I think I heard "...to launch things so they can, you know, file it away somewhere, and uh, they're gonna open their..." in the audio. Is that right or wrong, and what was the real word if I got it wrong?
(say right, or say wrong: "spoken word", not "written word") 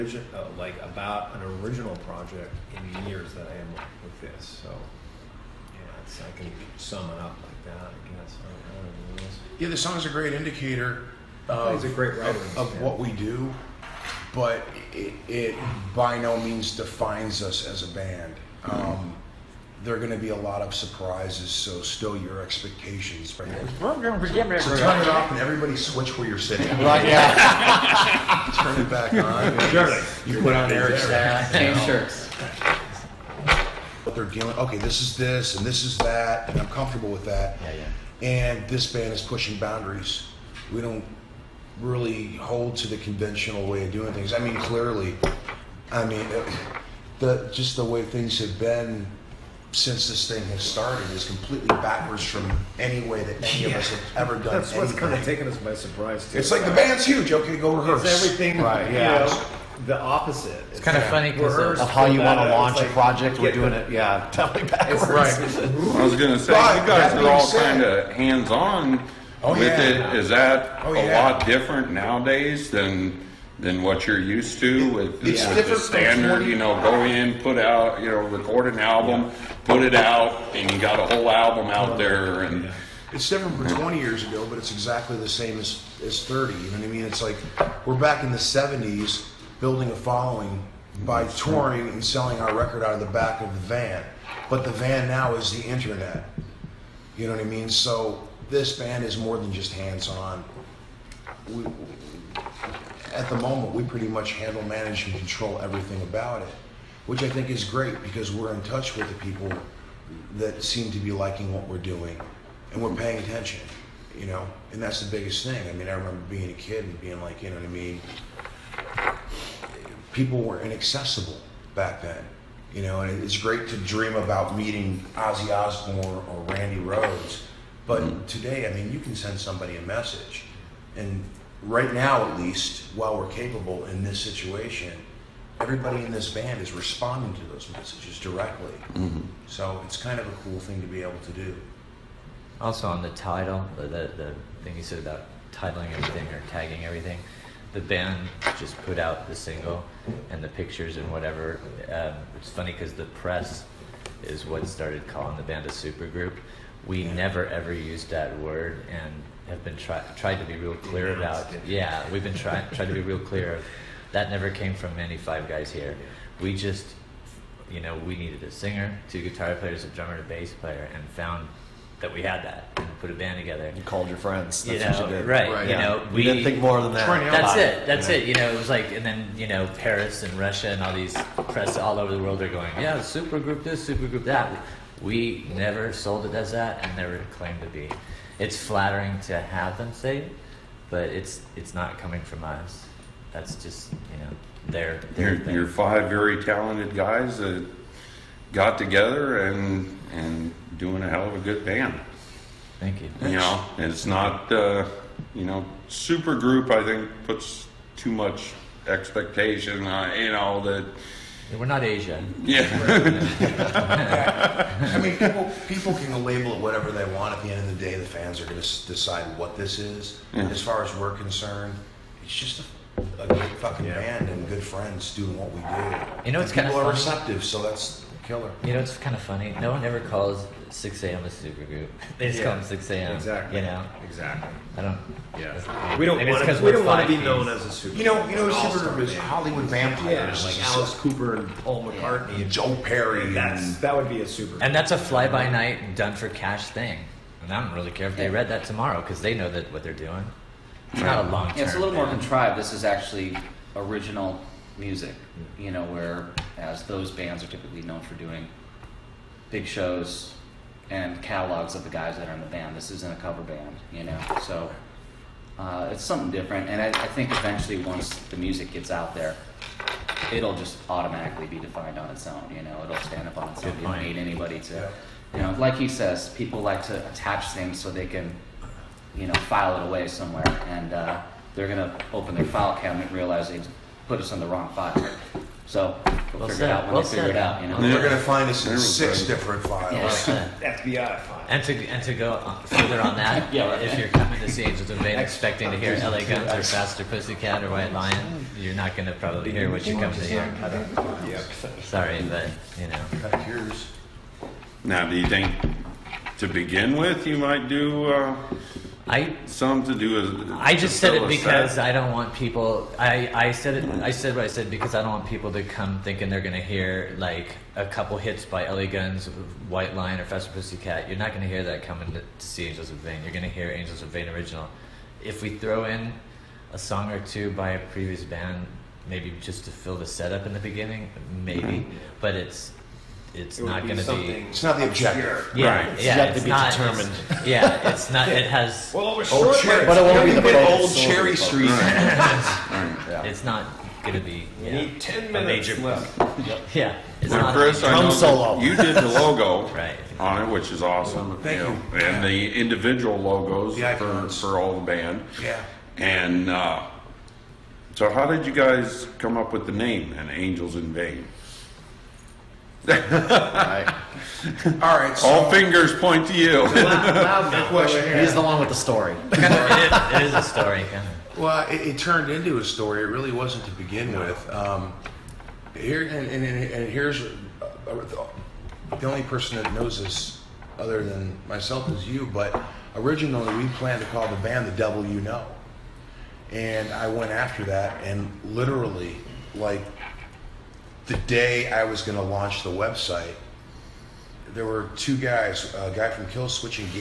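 wrong: "attach", not "launch".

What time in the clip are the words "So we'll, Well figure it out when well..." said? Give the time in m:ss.
4:45.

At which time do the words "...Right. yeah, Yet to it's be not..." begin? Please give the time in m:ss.
5:35.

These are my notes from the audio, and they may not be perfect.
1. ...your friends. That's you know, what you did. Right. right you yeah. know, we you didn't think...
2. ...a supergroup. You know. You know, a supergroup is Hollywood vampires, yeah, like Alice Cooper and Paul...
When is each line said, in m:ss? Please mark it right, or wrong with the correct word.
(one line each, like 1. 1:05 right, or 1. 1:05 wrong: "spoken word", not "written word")
1. 2:54 right
2. 3:57 right.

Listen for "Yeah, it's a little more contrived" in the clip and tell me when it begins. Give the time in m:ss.
4:11.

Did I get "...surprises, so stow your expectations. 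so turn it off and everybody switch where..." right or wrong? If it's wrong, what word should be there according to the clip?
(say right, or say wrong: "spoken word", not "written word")
right.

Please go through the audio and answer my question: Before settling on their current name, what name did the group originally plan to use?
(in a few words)
the Devil You Know.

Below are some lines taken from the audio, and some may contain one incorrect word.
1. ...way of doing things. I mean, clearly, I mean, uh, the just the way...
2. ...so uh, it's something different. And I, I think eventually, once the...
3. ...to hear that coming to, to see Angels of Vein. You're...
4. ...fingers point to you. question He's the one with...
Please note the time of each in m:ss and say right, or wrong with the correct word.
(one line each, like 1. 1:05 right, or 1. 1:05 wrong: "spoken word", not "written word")
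1. 0:43 right
2. 4:24 right
3. 5:21 right
4. 6:05 right.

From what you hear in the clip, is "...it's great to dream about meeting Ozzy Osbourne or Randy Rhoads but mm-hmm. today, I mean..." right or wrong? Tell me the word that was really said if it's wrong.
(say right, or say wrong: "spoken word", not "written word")
right.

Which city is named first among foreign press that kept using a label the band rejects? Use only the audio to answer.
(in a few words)
Paris.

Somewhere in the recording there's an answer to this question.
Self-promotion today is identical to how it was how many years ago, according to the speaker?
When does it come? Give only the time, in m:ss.
1:26.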